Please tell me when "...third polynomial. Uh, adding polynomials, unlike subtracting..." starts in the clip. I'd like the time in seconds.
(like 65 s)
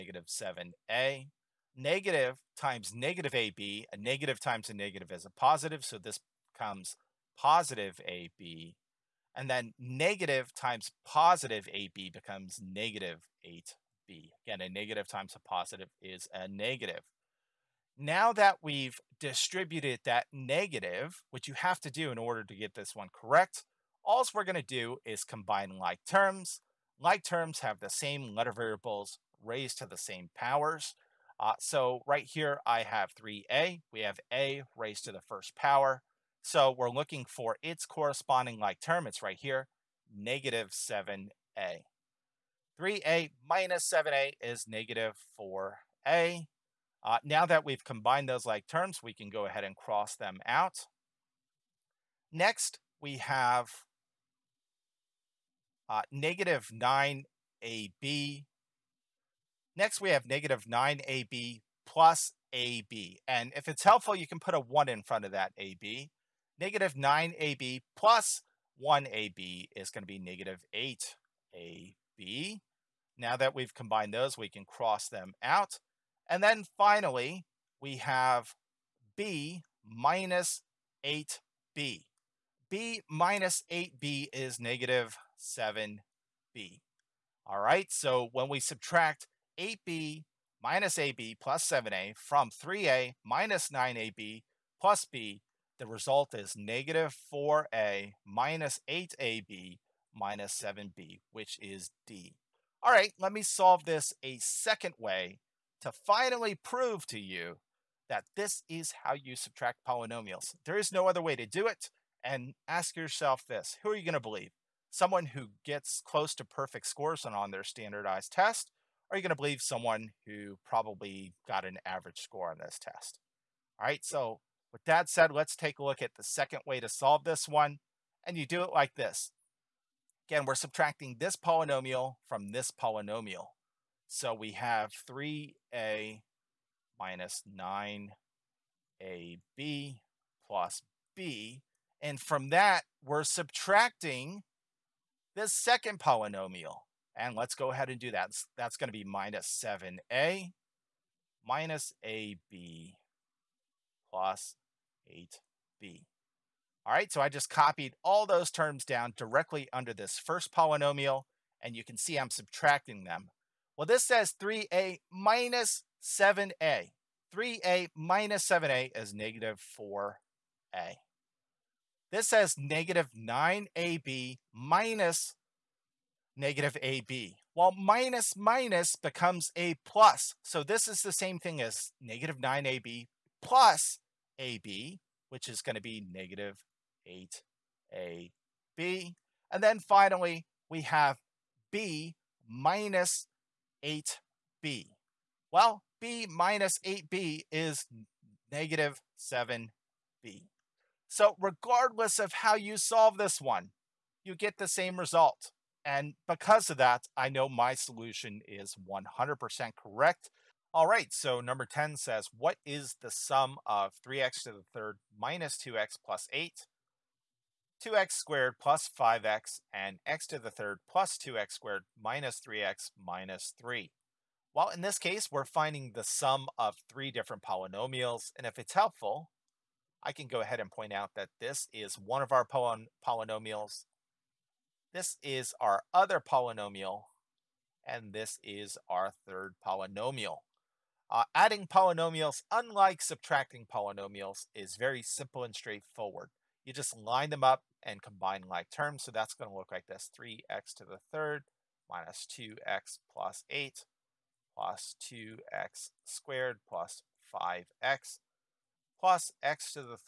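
239 s.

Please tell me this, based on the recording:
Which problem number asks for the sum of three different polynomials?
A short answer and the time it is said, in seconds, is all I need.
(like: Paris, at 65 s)
10, at 211 s.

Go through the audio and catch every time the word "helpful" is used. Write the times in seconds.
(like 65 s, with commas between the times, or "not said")
63 s, 228 s.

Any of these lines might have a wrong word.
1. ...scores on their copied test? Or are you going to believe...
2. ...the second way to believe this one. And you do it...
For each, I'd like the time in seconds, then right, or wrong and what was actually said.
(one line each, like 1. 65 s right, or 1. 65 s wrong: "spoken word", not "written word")
1. 116 s wrong: "standardized", not "copied"
2. 126 s wrong: "solve", not "believe".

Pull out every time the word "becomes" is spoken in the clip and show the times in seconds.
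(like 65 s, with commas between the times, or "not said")
6 s, 12 s, 178 s.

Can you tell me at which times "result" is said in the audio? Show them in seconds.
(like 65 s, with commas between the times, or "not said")
95 s, 204 s.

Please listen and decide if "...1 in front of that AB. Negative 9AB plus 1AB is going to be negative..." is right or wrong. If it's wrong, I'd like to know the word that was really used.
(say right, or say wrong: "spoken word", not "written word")
right.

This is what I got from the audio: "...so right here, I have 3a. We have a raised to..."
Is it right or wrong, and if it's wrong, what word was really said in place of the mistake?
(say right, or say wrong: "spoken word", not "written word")
right.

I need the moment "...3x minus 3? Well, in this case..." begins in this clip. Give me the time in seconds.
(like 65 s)
222 s.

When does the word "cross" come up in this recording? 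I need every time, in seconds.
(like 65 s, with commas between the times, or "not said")
49 s, 74 s.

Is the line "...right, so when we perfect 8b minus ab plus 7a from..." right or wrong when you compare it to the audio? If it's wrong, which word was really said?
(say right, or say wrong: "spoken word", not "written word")
wrong: "subtract", not "perfect".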